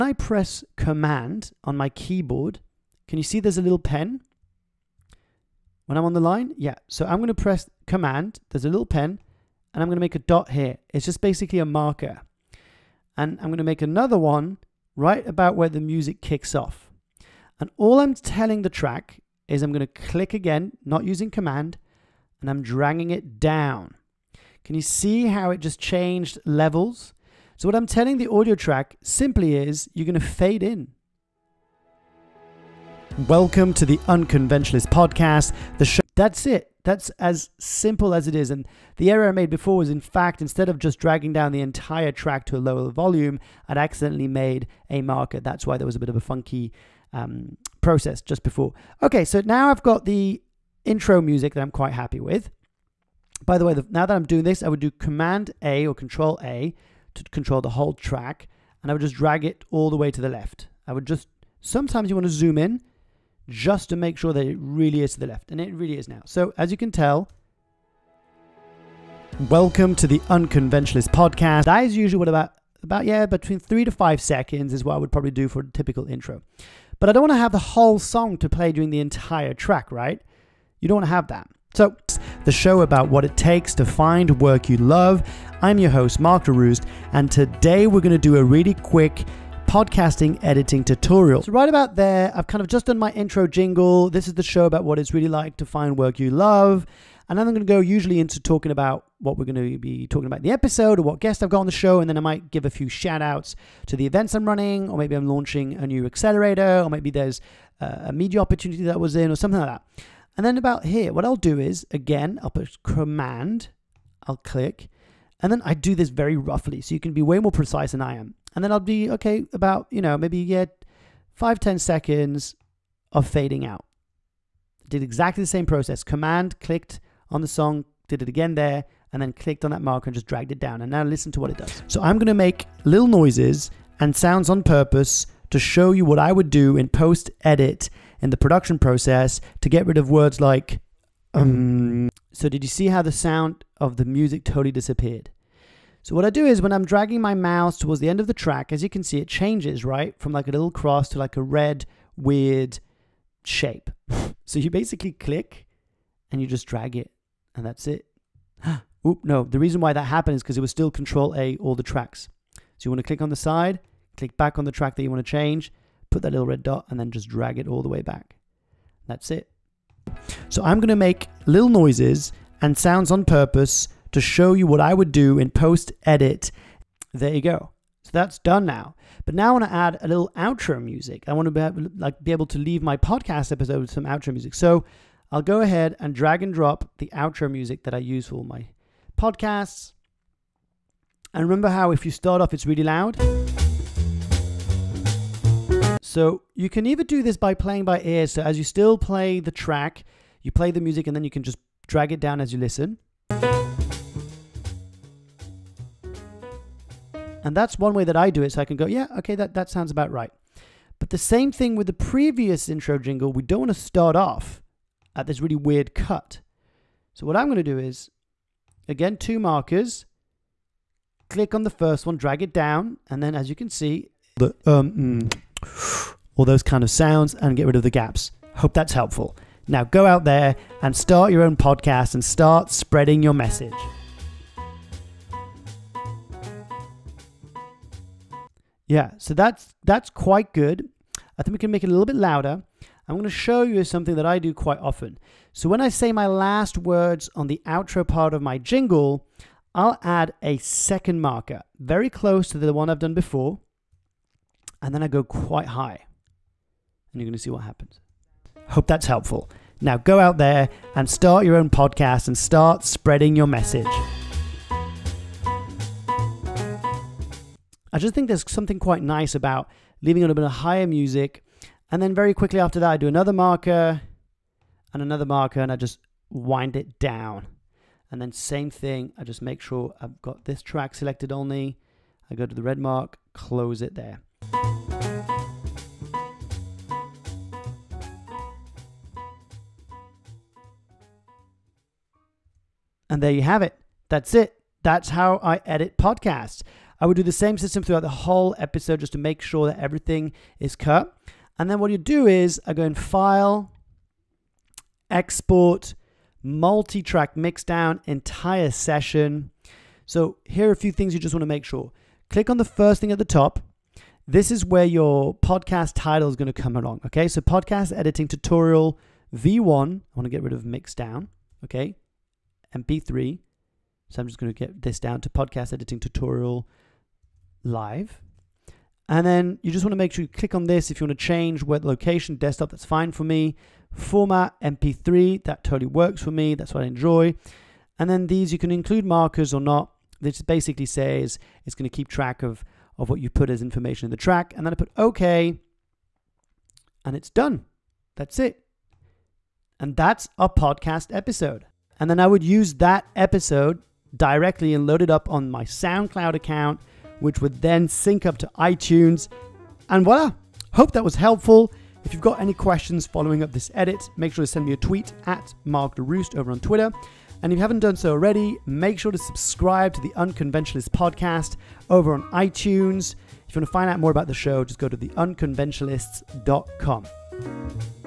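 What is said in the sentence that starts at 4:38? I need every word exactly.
And then same thing, I just make sure I've got this track selected only.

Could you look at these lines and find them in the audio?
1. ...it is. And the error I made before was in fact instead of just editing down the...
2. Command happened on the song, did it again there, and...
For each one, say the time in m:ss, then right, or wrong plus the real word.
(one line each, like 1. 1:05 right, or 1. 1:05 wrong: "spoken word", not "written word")
1. 0:38 wrong: "dragging", not "editing"
2. 2:06 wrong: "clicked", not "happened".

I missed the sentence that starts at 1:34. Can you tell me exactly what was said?
This is the show about what it's really like to find work you love.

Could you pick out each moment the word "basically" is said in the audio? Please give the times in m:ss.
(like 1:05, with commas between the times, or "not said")
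0:11, 2:34, 5:40.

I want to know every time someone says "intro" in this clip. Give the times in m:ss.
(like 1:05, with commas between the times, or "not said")
0:50, 1:16, 1:33, 3:32.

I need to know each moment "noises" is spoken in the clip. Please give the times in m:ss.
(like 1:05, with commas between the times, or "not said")
2:13, 2:51.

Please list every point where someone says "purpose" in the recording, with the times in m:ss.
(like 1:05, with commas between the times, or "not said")
2:14, 2:53.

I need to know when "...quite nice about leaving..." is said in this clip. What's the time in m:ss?
4:28.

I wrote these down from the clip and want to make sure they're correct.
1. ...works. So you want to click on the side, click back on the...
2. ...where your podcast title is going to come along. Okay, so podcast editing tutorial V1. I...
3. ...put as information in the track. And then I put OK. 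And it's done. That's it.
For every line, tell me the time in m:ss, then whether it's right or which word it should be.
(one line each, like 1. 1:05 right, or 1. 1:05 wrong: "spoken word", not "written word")
1. 2:41 wrong: "tracks", not "works"
2. 5:14 right
3. 5:43 right.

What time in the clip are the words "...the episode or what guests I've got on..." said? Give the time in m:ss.
1:40.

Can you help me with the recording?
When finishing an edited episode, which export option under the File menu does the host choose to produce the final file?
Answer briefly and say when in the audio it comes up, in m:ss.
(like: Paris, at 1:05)
Multi-Track Mixdown, at 5:06.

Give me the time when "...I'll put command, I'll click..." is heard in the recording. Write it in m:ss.
1:52.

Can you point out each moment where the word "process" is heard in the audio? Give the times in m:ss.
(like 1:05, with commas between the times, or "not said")
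0:47, 2:05, 2:18.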